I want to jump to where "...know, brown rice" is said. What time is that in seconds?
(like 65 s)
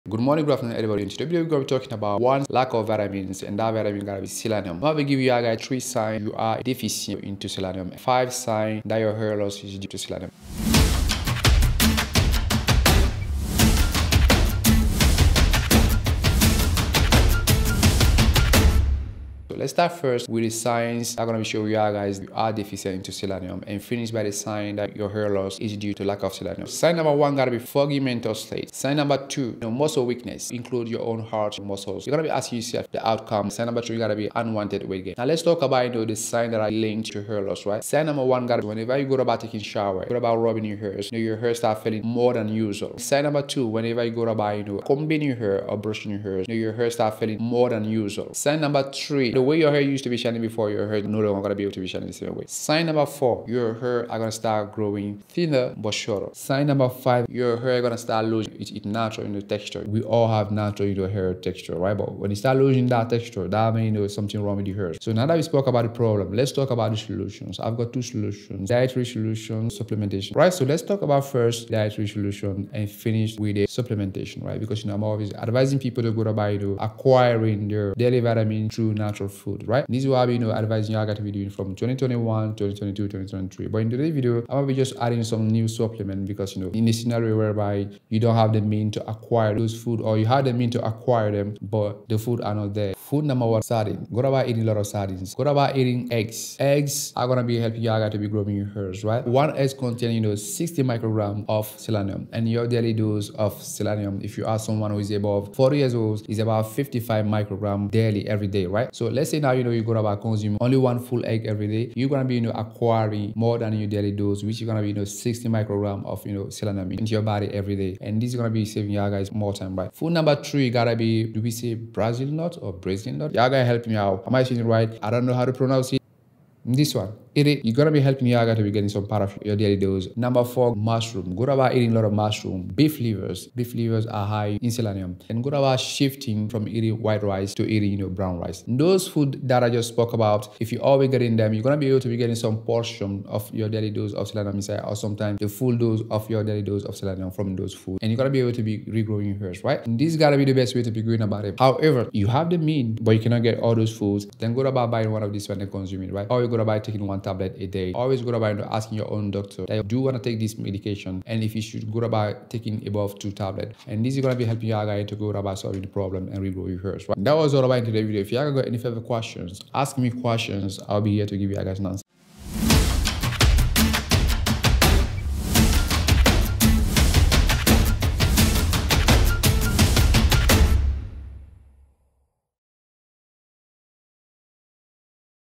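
137 s.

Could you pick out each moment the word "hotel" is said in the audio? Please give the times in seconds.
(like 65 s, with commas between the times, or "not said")
not said.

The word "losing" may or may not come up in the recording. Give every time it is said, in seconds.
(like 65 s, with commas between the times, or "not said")
58 s, 62 s.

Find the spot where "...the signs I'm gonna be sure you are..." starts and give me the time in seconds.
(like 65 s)
20 s.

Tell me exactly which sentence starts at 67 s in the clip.
I've got two solutions, dietary solution, supplementation, right?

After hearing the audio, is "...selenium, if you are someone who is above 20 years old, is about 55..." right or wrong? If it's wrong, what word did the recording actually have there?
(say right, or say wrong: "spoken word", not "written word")
wrong: "40", not "20".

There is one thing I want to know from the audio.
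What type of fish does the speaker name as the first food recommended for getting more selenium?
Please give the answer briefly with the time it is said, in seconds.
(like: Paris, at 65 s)
Sardine, at 93 s.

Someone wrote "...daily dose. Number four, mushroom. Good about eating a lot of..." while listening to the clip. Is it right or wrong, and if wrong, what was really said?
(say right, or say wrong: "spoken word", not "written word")
right.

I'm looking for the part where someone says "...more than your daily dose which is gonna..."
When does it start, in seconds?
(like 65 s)
113 s.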